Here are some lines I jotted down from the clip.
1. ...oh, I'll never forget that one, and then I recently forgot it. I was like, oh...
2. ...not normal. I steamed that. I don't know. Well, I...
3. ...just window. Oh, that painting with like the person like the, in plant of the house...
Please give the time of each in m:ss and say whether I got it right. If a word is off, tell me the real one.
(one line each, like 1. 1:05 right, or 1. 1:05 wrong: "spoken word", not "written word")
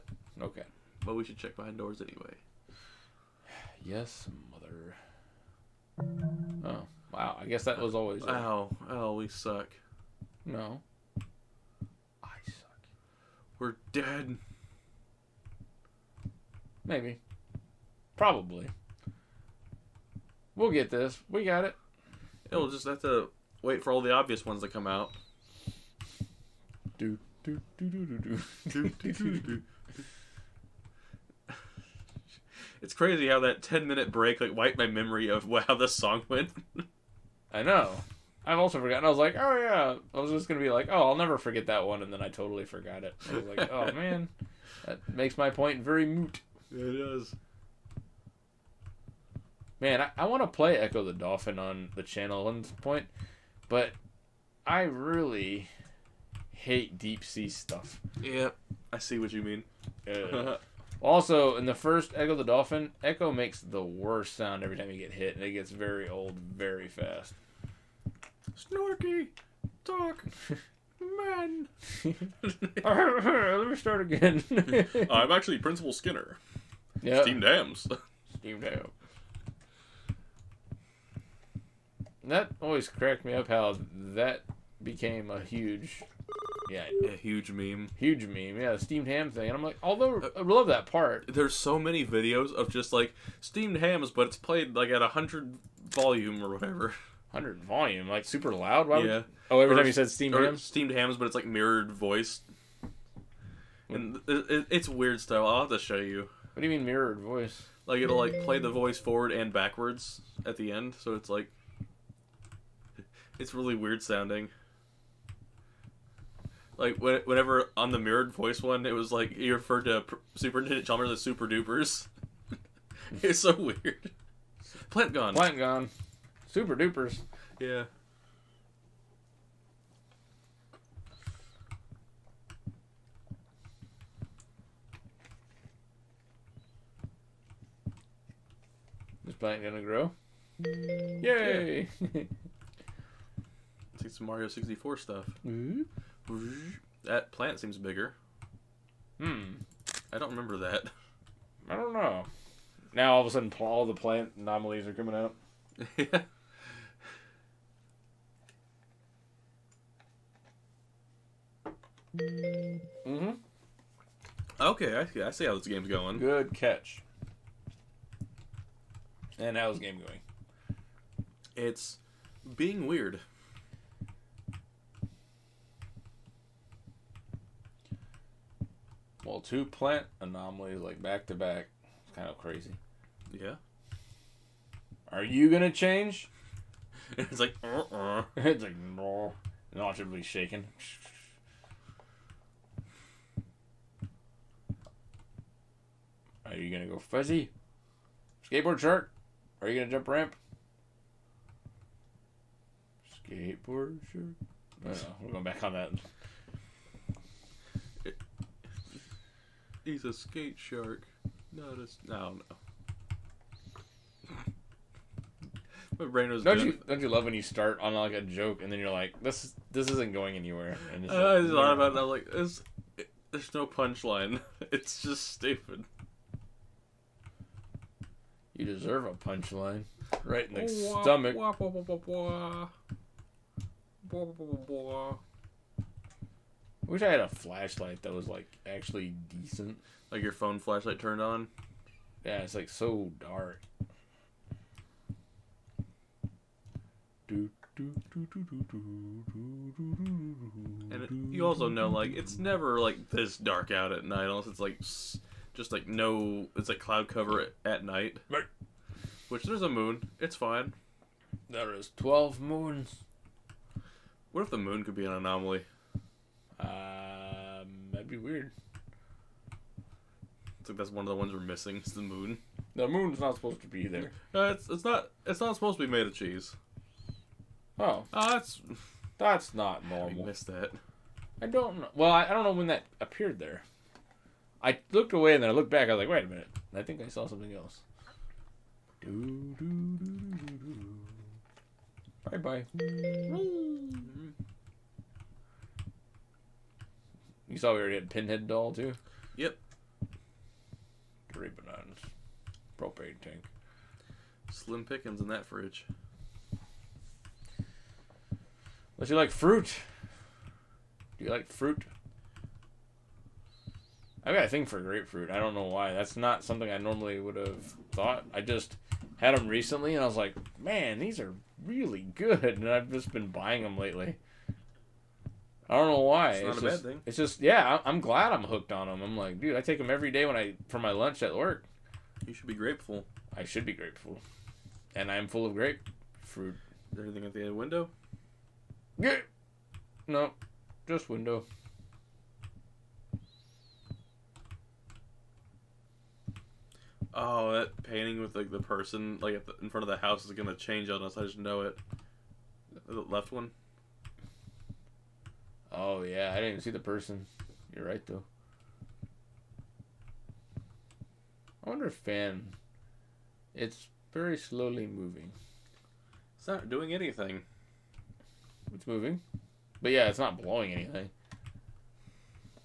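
1. 0:40 wrong: "totally", not "recently"
2. 4:39 wrong: "missed", not "steamed"
3. 5:40 wrong: "front", not "plant".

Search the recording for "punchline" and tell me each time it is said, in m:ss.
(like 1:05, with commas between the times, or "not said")
3:43, 3:49.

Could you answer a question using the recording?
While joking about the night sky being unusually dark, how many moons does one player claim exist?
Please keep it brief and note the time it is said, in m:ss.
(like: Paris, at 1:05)
12, at 4:21.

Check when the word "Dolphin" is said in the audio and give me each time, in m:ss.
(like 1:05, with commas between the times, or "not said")
0:51, 1:02.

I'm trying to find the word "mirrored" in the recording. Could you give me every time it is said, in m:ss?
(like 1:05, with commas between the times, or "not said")
1:41, 1:46, 1:57.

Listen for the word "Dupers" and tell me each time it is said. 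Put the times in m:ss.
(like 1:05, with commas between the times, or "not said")
2:01, 2:06.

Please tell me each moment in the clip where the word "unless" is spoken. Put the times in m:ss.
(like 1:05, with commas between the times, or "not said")
4:14, 5:08.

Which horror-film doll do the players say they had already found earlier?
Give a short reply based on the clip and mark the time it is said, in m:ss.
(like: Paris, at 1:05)
Pinhead doll, at 4:58.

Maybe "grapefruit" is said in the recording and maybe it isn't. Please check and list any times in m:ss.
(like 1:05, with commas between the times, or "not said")
5:14, 5:35.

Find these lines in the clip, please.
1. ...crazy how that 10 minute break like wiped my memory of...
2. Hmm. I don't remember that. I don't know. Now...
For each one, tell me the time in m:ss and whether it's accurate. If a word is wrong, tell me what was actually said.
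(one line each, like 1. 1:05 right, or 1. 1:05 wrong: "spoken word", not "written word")
1. 0:32 right
2. 2:29 right.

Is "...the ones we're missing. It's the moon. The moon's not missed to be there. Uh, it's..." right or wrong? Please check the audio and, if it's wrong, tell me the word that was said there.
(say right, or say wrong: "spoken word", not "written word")
wrong: "supposed", not "missed".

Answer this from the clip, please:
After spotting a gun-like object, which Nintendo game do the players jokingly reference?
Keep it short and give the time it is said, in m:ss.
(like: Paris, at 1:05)
Mario 64, at 2:24.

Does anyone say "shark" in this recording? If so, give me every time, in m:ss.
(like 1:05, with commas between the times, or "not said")
3:18, 3:24, 3:30.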